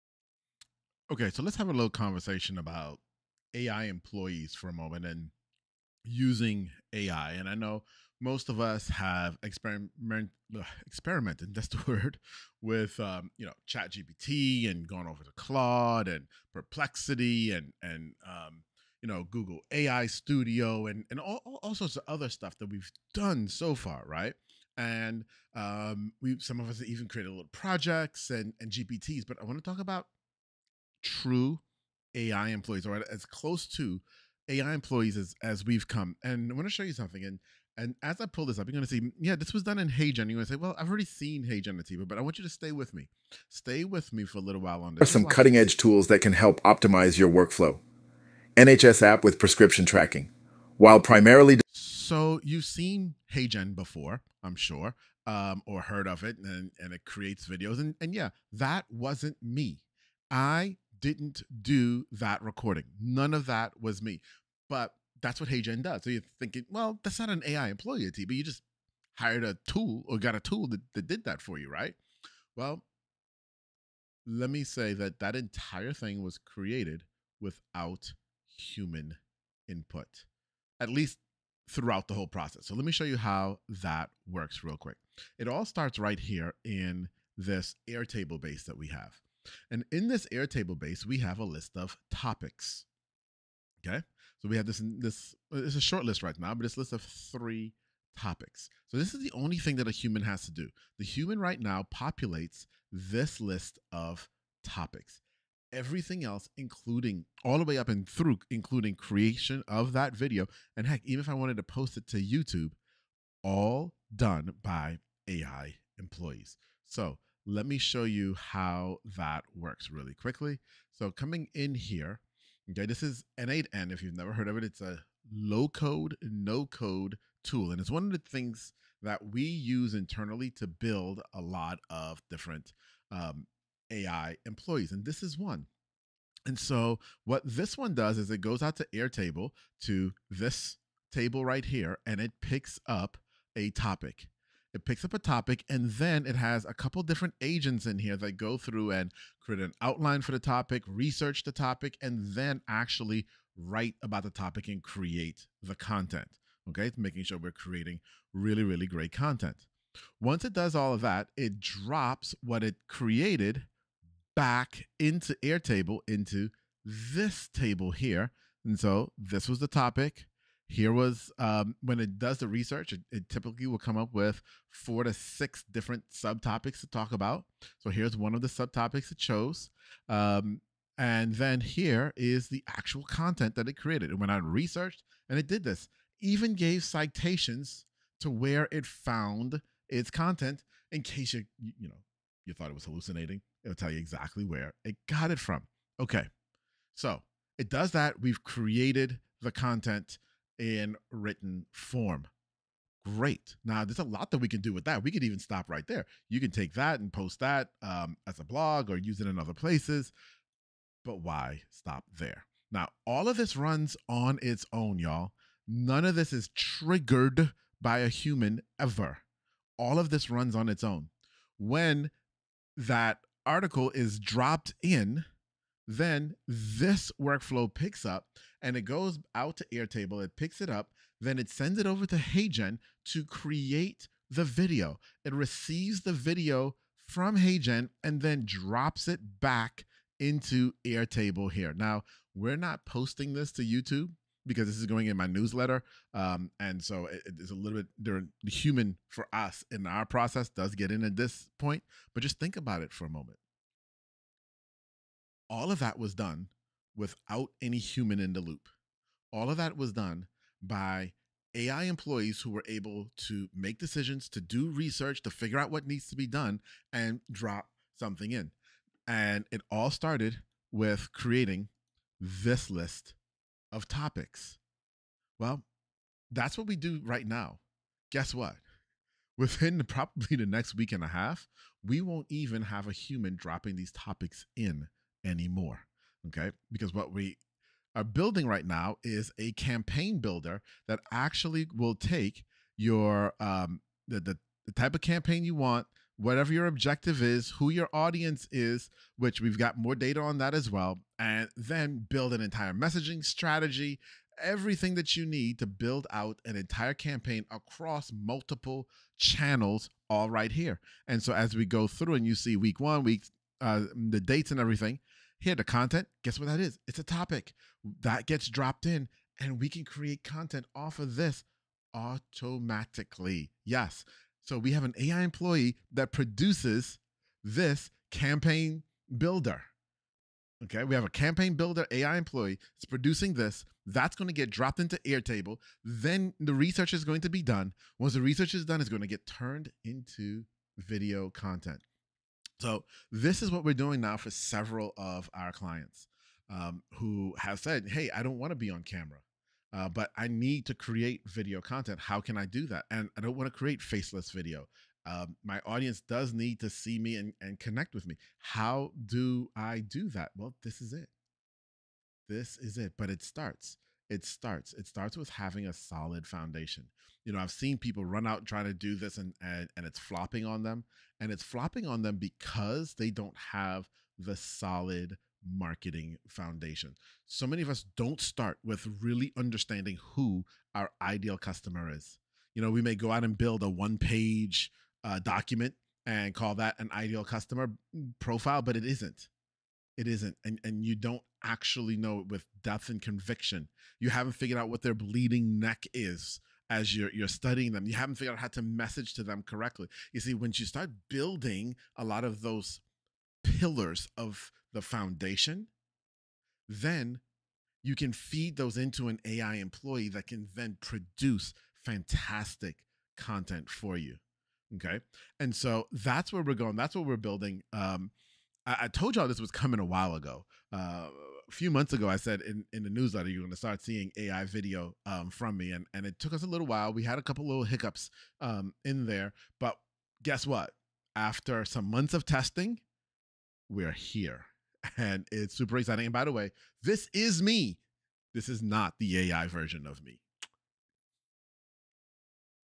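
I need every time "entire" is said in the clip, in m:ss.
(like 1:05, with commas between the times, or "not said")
1:15, 5:02, 5:06.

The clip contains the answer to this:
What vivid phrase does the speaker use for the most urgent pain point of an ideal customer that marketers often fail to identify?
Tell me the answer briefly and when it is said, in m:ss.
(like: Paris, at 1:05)
Bleeding neck, at 6:34.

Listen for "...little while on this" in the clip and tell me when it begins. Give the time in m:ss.
0:44.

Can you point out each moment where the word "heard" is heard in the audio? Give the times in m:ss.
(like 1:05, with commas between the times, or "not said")
0:55, 2:04.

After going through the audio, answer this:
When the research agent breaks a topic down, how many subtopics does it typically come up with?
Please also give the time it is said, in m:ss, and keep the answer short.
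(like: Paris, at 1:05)
4 to 6, at 2:54.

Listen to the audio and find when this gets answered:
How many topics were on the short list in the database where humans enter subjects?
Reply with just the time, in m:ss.
1:36.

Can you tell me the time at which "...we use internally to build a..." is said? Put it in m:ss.
2:09.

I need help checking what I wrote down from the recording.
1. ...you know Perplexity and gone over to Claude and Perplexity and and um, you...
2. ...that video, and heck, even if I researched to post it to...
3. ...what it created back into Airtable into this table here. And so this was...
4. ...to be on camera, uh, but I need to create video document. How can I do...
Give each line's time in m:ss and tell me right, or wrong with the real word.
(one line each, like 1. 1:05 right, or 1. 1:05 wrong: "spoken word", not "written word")
1. 0:13 wrong: "ChatGPT", not "Perplexity"
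2. 1:49 wrong: "wanted", not "researched"
3. 2:42 right
4. 5:48 wrong: "content", not "document".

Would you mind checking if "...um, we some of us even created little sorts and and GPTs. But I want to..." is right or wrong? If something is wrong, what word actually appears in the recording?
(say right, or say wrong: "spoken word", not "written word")
wrong: "projects", not "sorts".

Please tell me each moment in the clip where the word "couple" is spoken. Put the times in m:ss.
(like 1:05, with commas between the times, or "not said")
2:26, 7:07.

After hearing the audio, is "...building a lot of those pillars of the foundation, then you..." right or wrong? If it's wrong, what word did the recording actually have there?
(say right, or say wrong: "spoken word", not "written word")
right.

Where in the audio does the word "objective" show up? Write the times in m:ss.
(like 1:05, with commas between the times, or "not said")
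4:56.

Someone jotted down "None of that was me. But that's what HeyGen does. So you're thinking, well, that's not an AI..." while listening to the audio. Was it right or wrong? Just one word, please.
right.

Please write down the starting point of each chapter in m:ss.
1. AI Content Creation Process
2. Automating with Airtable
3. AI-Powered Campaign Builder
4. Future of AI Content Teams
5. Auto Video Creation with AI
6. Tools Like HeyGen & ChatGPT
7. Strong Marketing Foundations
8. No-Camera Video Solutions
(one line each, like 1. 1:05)
1. 2:50
2. 1:50
3. 5:15
4. 7:15
5. 4:30
6. 0:45
7. 6:35
8. 6:00.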